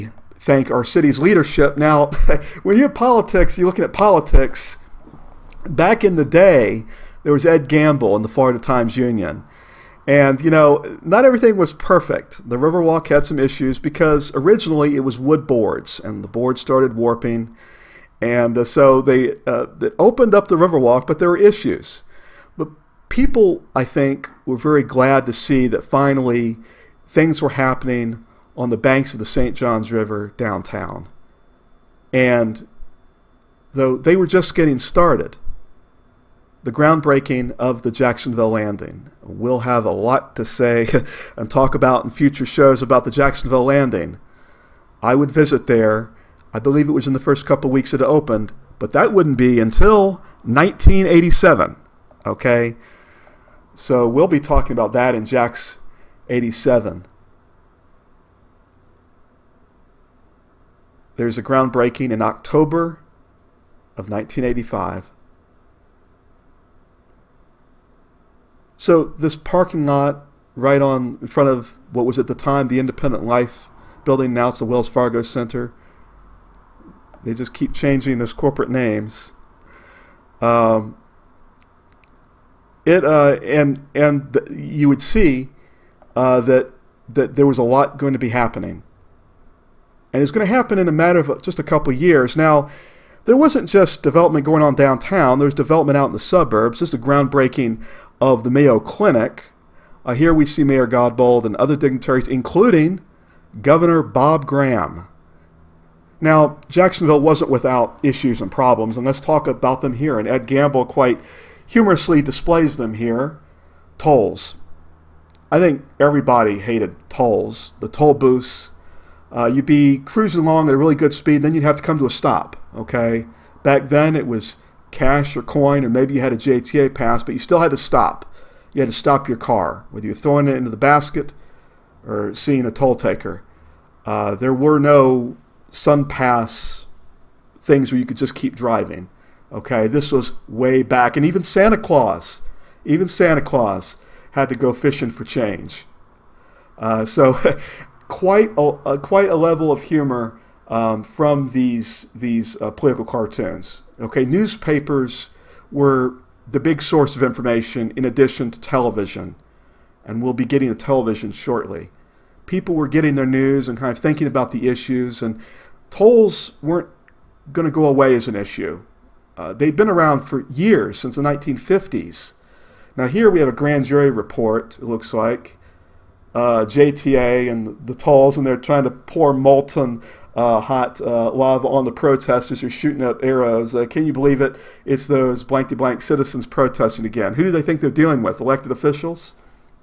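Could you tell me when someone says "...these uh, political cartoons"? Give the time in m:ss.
2:32.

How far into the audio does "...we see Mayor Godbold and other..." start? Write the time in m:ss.
1:40.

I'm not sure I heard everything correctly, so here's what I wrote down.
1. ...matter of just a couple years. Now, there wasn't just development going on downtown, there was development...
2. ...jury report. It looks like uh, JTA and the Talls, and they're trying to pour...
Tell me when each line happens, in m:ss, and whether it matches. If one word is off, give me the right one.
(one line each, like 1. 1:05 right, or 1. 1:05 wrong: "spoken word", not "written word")
1. 1:30 right
2. 2:53 right.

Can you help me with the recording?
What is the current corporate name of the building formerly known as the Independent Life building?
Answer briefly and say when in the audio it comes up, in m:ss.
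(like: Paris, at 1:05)
Wells Fargo Center, at 1:14.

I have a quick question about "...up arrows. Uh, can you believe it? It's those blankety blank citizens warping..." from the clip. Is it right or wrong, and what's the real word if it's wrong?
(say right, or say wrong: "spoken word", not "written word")
wrong: "protesting", not "warping".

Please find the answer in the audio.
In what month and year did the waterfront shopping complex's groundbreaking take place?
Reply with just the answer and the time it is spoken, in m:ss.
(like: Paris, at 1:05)
October 1985, at 1:02.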